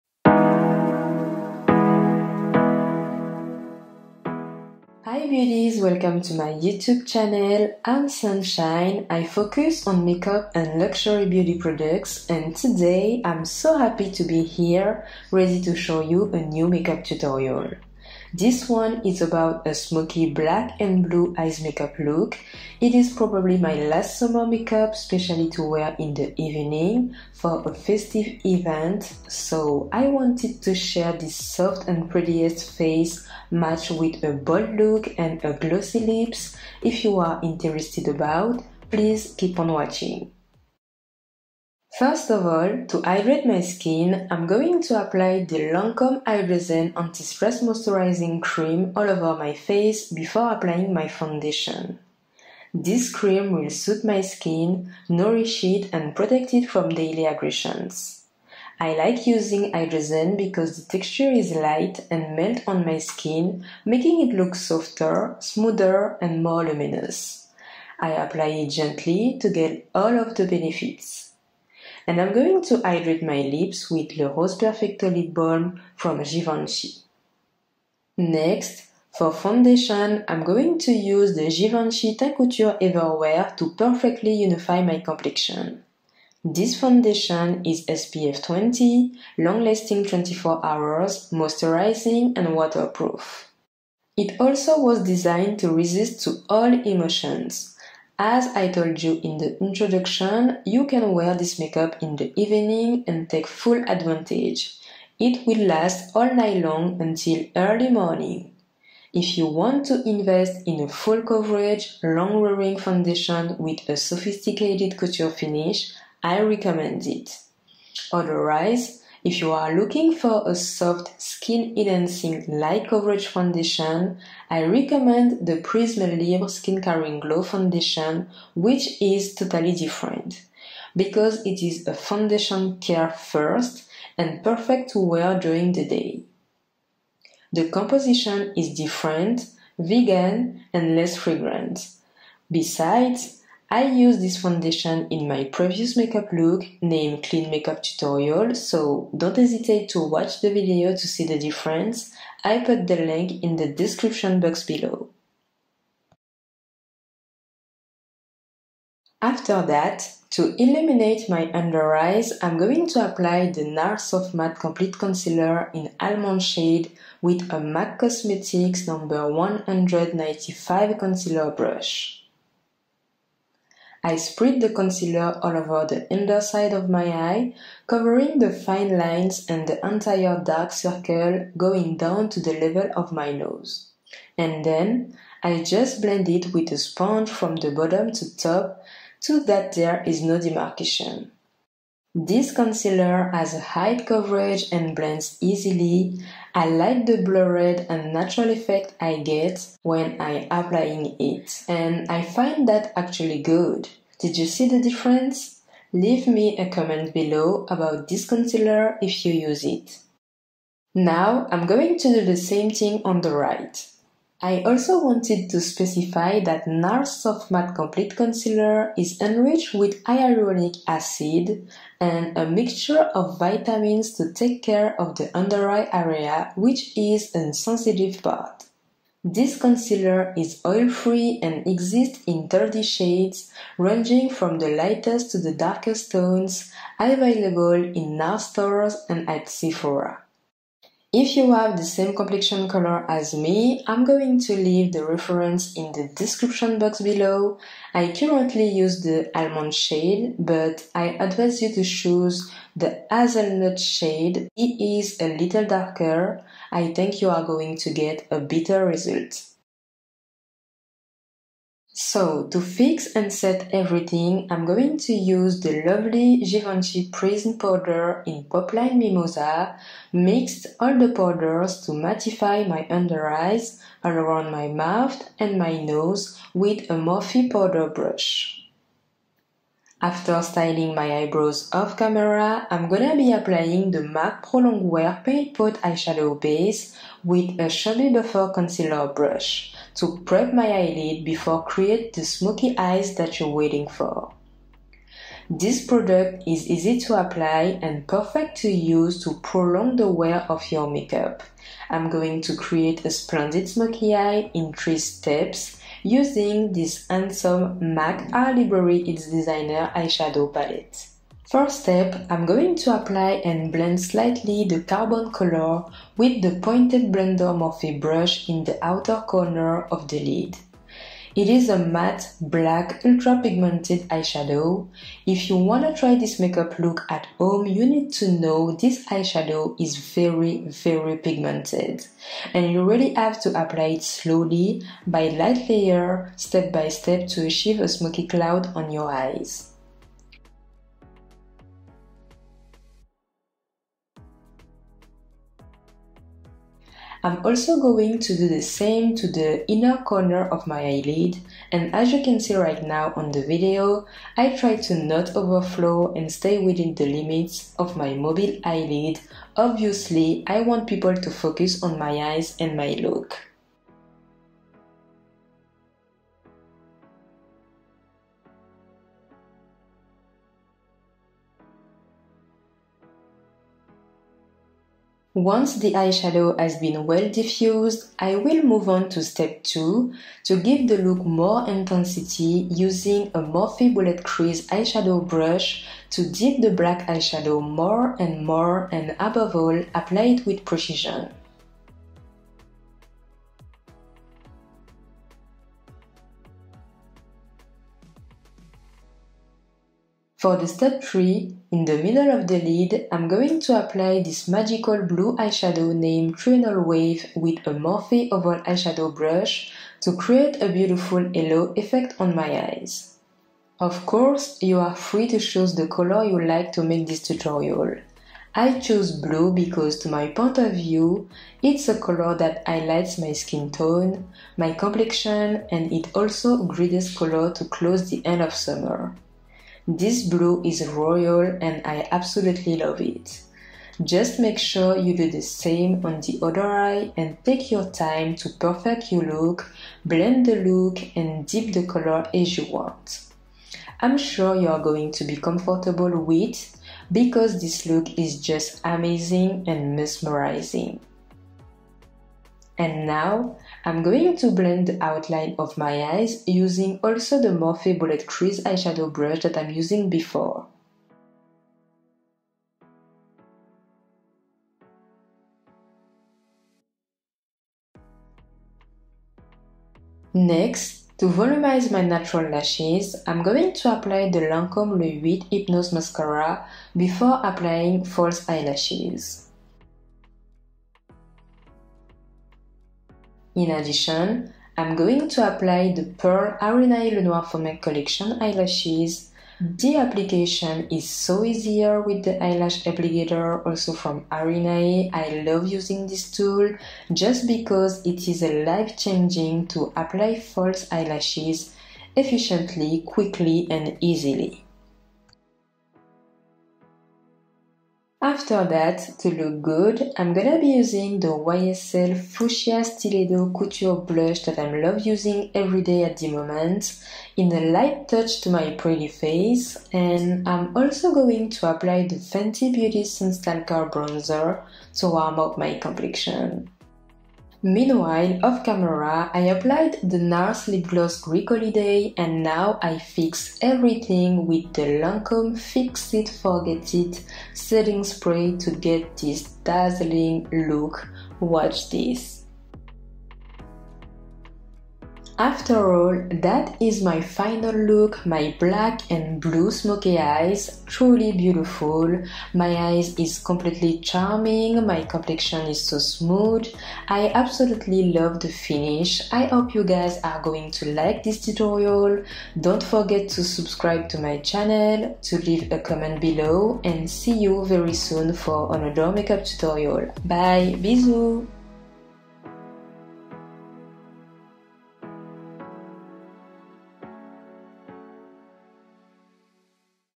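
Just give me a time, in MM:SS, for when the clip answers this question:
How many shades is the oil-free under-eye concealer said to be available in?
03:52.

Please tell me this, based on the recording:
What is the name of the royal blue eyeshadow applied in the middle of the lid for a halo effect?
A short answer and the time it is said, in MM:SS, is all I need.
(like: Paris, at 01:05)
Trinal Wave, at 06:46.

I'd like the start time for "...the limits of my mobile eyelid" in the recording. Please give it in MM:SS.
05:56.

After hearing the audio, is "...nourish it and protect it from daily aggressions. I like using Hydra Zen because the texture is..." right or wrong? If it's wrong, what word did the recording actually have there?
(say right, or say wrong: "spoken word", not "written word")
right.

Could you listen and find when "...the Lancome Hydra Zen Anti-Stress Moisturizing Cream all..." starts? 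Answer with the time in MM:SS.
00:45.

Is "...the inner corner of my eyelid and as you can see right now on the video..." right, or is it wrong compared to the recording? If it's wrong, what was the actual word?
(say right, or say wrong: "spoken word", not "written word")
right.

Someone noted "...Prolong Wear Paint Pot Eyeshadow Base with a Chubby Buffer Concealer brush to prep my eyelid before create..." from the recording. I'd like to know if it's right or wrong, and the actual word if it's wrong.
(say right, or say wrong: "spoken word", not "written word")
right.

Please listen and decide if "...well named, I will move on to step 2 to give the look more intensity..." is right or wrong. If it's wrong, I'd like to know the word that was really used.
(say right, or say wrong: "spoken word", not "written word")
wrong: "diffused", not "named".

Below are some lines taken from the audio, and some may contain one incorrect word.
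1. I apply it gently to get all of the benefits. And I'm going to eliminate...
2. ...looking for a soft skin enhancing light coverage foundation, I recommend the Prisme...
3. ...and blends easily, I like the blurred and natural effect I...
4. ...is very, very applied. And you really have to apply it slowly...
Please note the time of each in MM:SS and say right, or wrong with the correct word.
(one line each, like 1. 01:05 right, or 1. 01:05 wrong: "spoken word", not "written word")
1. 01:07 wrong: "hydrate", not "eliminate"
2. 01:59 right
3. 03:14 right
4. 05:29 wrong: "pigmented", not "applied".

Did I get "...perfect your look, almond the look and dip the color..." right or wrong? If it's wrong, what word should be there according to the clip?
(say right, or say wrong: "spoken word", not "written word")
wrong: "blend", not "almond".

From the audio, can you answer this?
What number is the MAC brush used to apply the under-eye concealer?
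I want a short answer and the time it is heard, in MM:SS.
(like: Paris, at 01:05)
195, at 02:49.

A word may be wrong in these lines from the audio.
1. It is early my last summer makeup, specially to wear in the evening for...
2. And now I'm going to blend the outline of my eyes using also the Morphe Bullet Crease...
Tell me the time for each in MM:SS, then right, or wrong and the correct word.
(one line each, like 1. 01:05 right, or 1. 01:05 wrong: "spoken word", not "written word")
1. 00:22 wrong: "probably", not "early"
2. 07:32 right.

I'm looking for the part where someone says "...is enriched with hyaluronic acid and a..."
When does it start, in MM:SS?
03:38.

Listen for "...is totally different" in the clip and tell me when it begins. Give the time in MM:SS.
02:08.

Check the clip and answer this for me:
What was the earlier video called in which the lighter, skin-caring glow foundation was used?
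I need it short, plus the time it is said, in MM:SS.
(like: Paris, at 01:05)
Clean Makeup Tutorial, at 02:27.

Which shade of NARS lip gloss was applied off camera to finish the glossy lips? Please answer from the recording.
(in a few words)
Greek Holiday.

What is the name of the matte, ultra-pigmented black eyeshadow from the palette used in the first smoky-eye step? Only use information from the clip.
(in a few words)
Carbon.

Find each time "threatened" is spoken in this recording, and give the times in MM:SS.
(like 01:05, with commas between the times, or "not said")
not said.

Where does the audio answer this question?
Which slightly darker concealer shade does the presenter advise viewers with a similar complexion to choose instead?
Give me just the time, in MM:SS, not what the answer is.
04:13.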